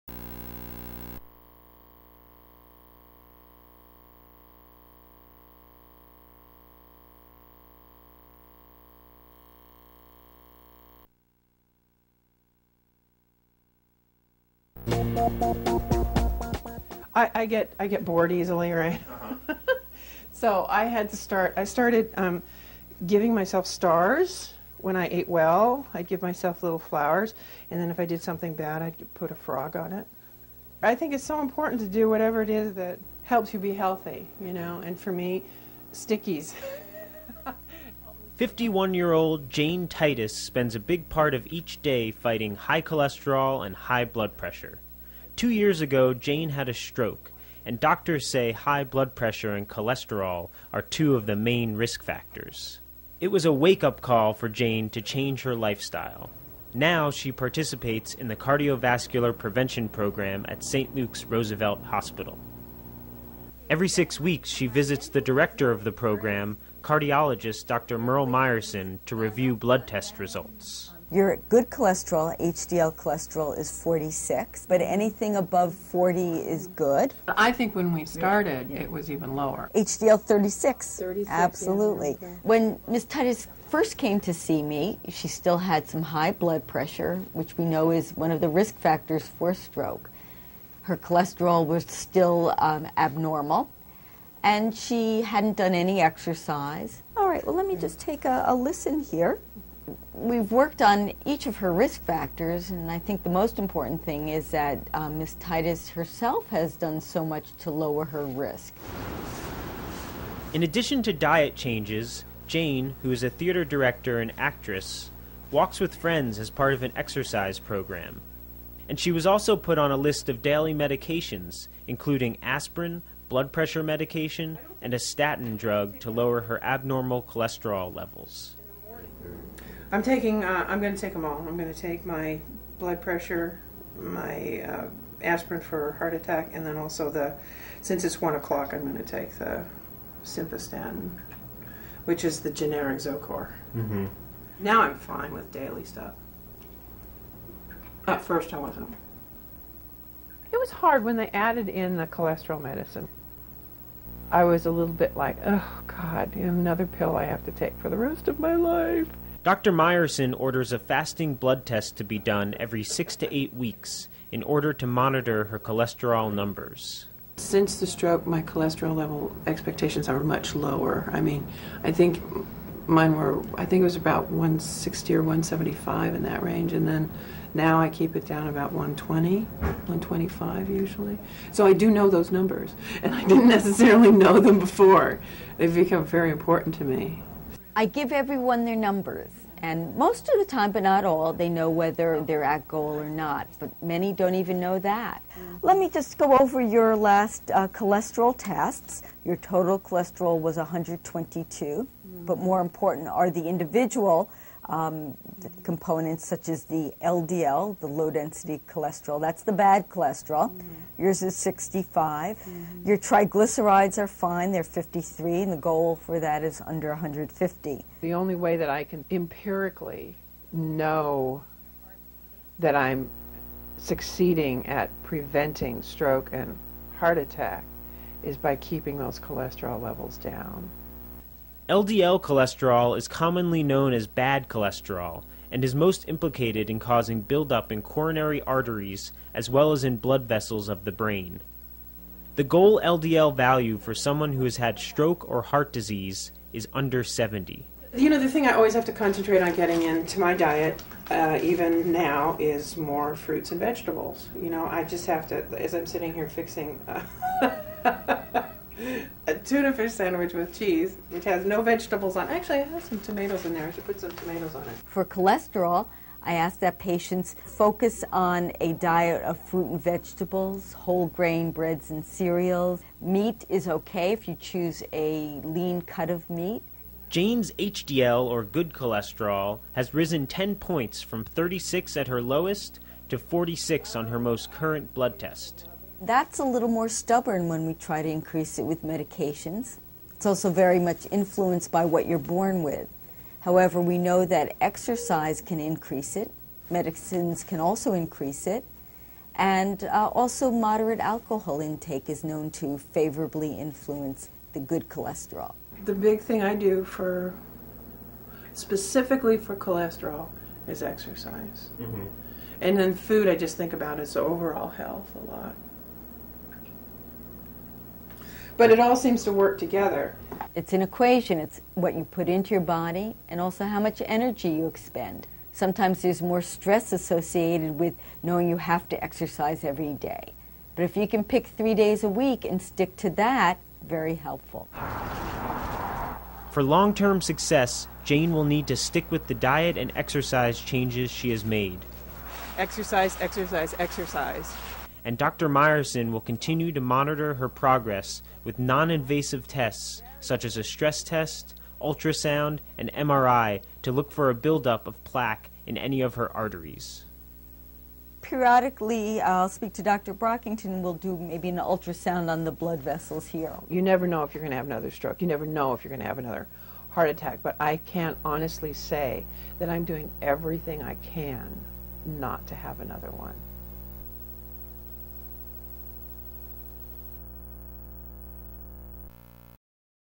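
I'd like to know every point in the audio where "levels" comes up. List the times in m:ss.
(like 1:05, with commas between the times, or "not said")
2:07, 2:48, 3:49.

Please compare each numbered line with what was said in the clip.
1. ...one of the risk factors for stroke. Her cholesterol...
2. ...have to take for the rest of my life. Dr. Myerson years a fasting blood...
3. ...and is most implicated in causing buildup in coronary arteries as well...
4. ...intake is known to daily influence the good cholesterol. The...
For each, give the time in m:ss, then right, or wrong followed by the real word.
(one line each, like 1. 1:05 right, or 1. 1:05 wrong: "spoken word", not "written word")
1. 1:28 right
2. 2:37 wrong: "orders", not "years"
3. 3:55 right
4. 5:01 wrong: "favorably", not "daily".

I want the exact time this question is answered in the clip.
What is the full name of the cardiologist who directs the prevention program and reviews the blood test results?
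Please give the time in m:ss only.
1:07.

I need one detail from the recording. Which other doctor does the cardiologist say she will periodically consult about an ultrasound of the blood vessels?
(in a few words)
Dr. Brockington.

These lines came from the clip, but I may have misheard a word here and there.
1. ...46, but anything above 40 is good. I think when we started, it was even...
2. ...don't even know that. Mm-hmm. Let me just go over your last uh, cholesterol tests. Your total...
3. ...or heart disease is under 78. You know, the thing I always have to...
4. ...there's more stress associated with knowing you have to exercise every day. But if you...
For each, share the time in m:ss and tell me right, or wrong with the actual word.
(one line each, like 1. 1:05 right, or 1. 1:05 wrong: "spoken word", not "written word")
1. 1:13 right
2. 3:14 right
3. 4:05 wrong: "70", not "78"
4. 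5:26 right.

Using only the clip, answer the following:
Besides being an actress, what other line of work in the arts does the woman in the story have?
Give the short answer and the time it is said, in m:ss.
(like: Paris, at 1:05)
Theater director, at 1:53.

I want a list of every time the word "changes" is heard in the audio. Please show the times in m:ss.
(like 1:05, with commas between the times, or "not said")
0:55, 1:51, 5:40.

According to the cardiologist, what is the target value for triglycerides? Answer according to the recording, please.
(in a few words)
Under 150.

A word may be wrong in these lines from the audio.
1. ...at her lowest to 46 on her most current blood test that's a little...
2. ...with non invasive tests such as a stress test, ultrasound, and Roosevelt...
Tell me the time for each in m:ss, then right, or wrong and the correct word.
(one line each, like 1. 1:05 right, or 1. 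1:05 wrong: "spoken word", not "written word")
1. 4:41 right
2. 5:48 wrong: "MRI", not "Roosevelt".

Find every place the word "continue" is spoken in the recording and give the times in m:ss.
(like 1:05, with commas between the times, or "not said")
5:46.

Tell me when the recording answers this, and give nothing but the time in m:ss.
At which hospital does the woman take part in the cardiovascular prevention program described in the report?
1:00.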